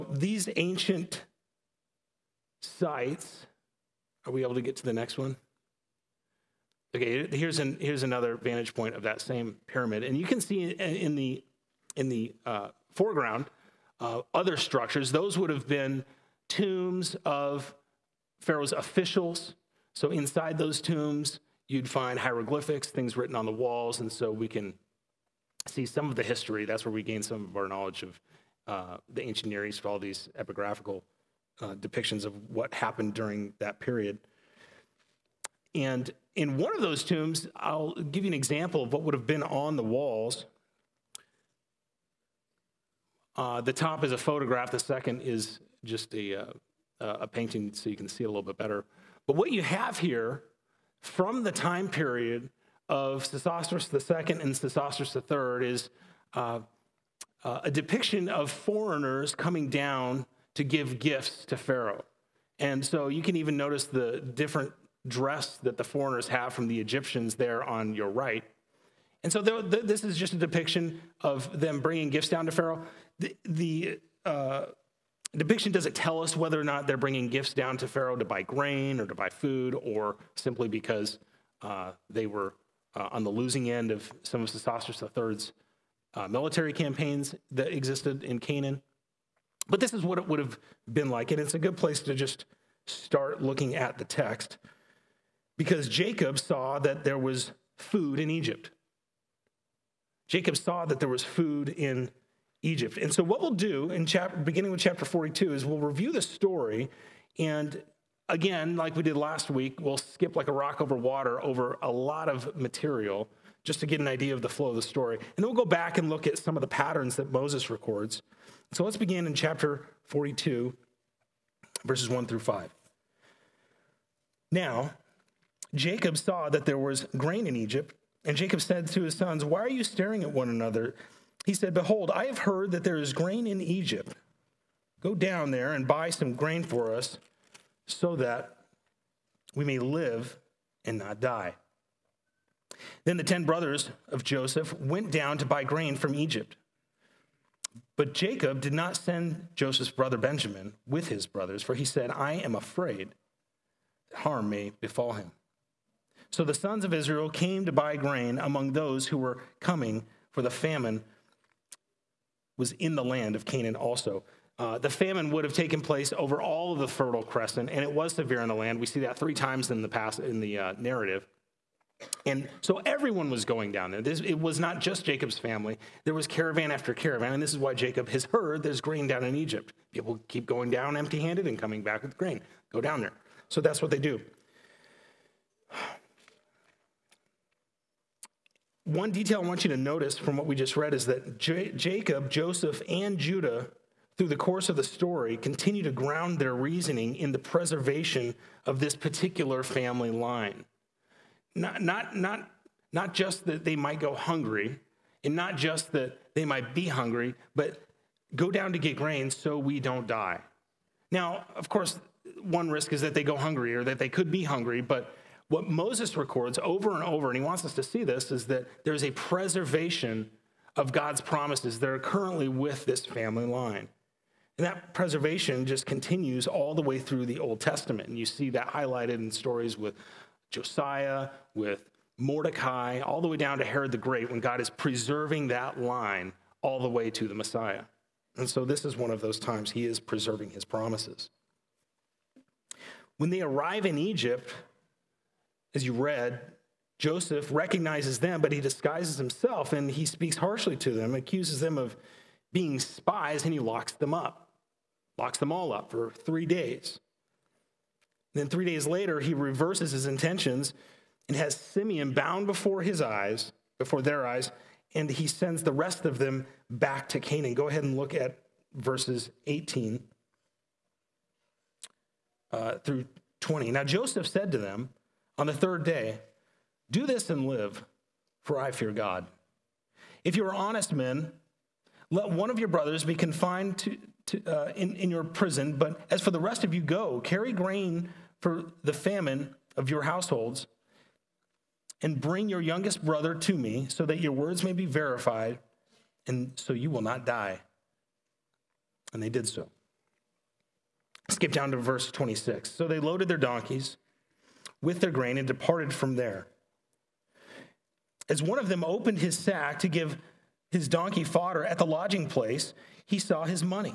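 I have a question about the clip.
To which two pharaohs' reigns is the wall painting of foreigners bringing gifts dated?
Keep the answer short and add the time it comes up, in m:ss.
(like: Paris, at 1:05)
Sesostris II and Sesostris III, at 0:53.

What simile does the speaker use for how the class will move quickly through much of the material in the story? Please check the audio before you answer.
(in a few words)
Like a rock over water.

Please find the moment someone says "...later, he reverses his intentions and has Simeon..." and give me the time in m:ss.
4:18.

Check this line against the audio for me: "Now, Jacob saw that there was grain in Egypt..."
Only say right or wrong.
right.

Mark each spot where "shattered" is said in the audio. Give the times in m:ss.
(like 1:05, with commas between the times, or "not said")
not said.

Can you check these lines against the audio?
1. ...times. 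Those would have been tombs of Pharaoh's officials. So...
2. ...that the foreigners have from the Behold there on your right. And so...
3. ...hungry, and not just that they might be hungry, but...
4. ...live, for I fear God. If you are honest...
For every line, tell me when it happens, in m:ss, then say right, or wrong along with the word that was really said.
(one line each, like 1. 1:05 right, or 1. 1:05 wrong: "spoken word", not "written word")
1. 0:14 wrong: "structures", not "times"
2. 1:05 wrong: "Egyptians", not "Behold"
3. 3:24 right
4. 4:37 right.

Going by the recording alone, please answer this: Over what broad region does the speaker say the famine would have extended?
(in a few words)
The Fertile Crescent.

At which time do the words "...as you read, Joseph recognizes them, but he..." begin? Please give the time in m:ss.
4:05.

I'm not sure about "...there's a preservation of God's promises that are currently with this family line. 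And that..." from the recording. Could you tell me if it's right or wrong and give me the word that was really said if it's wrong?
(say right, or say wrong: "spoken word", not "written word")
right.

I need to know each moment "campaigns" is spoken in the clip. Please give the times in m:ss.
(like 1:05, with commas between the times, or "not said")
1:26.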